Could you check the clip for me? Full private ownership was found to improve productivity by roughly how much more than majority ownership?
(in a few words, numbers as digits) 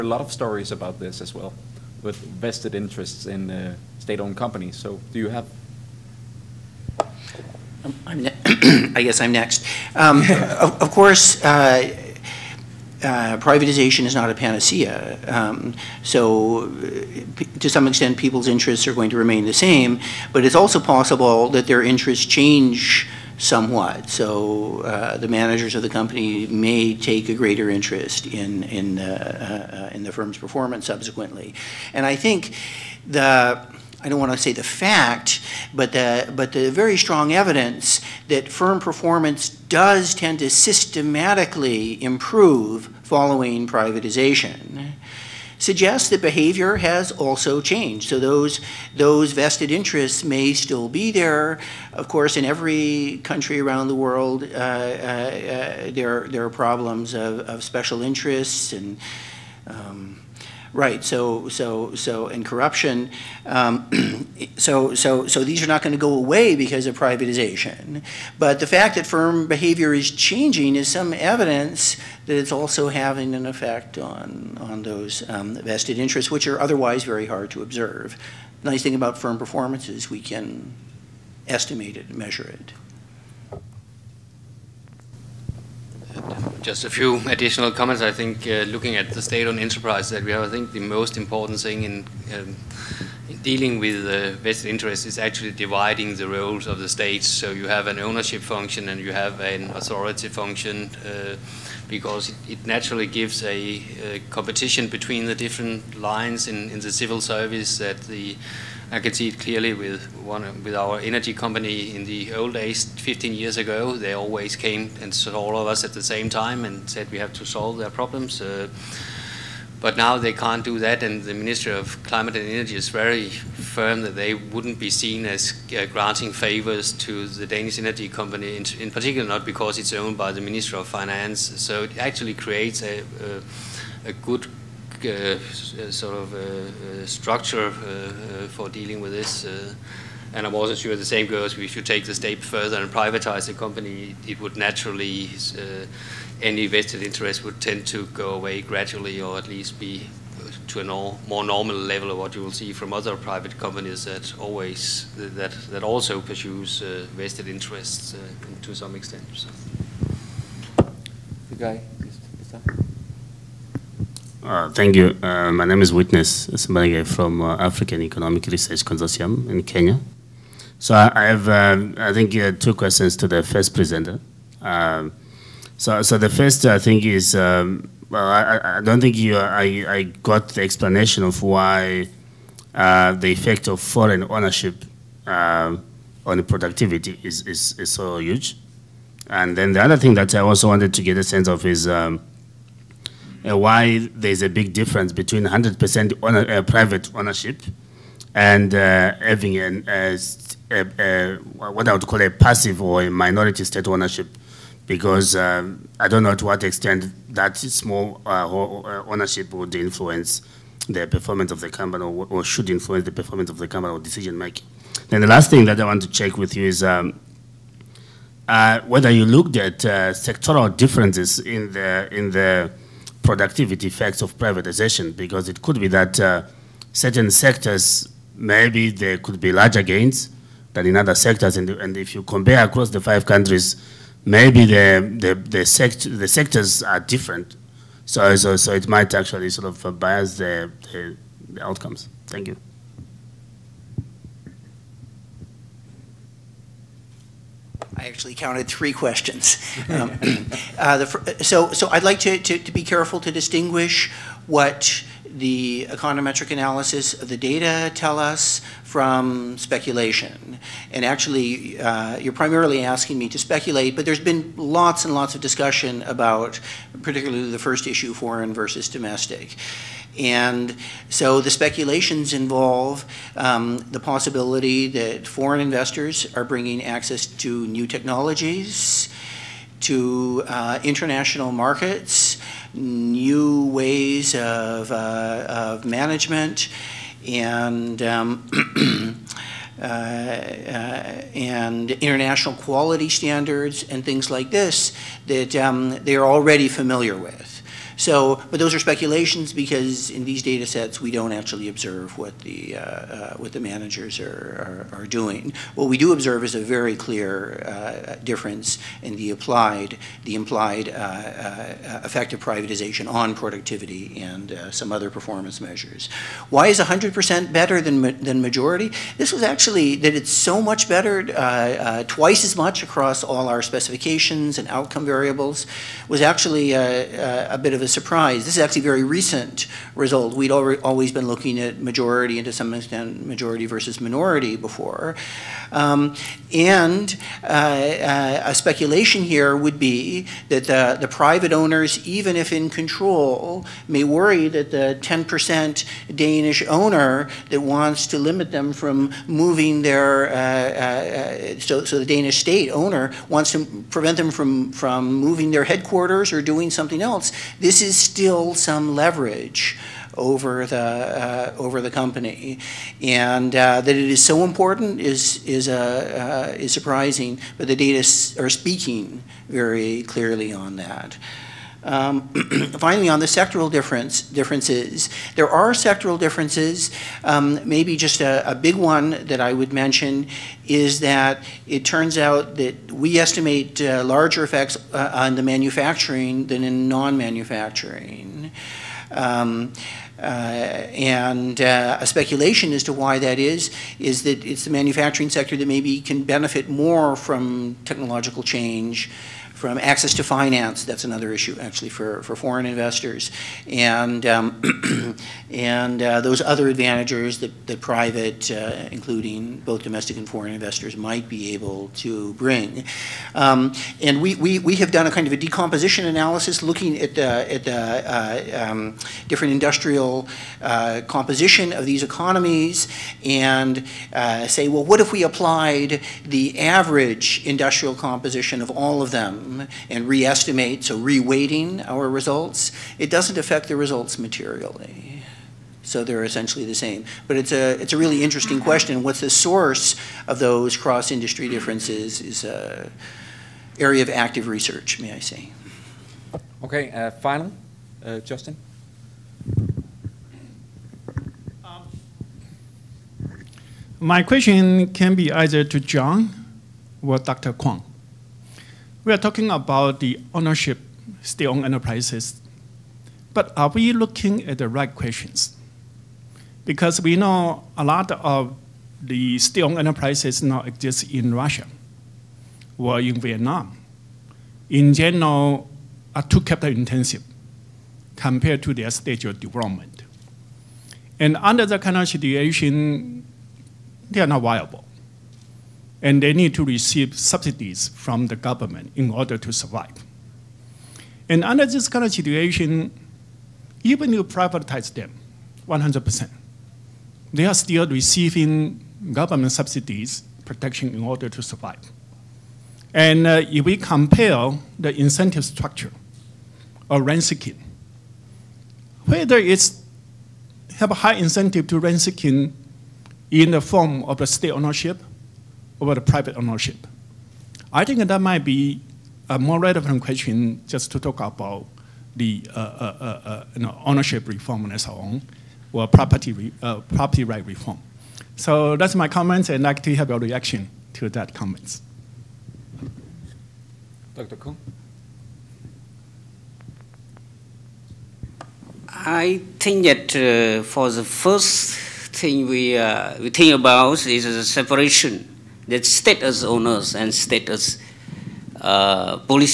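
twice as much.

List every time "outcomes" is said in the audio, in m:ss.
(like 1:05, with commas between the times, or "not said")
4:01, 5:24.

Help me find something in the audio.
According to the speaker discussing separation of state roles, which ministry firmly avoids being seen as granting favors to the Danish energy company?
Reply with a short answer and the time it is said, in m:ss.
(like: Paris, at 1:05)
Ministry of Climate and Energy, at 2:01.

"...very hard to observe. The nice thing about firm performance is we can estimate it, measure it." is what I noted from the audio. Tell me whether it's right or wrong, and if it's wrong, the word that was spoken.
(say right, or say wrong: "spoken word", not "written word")
right.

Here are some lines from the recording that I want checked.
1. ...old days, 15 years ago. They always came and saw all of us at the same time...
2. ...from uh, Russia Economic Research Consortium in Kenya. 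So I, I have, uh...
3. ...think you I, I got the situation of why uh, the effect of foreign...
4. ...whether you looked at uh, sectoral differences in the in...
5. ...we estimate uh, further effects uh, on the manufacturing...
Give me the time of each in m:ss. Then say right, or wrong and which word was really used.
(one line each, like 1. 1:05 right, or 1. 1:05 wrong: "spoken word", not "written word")
1. 1:52 right
2. 2:47 wrong: "African", not "Russia"
3. 2:58 wrong: "explanation", not "situation"
4. 3:38 right
5. 6:22 wrong: "larger", not "further".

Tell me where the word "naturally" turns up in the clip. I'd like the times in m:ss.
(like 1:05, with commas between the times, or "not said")
1:42, 2:24.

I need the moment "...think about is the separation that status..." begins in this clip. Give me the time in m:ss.
9:03.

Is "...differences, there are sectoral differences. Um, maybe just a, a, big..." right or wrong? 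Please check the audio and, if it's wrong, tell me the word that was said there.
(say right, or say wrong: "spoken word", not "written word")
right.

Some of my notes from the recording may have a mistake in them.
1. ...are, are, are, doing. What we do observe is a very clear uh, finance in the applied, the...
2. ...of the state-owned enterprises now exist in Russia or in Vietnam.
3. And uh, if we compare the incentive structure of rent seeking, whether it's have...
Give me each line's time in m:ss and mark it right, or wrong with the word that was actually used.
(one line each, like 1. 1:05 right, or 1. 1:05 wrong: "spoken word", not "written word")
1. 5:04 wrong: "difference", not "finance"
2. 7:48 right
3. 8:22 right.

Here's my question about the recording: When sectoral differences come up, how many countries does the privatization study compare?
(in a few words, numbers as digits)
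5.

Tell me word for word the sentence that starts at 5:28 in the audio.
This is actually a very recent result.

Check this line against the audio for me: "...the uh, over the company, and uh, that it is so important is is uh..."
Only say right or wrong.
right.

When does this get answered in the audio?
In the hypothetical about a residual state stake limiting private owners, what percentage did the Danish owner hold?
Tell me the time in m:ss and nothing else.
5:44.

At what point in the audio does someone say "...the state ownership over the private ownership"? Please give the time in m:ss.
8:34.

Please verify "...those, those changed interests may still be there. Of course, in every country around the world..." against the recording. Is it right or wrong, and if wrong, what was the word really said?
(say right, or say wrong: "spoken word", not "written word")
wrong: "vested", not "changed".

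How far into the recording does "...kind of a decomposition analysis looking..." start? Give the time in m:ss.
6:55.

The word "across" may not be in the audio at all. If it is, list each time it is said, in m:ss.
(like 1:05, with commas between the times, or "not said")
3:52, 5:22.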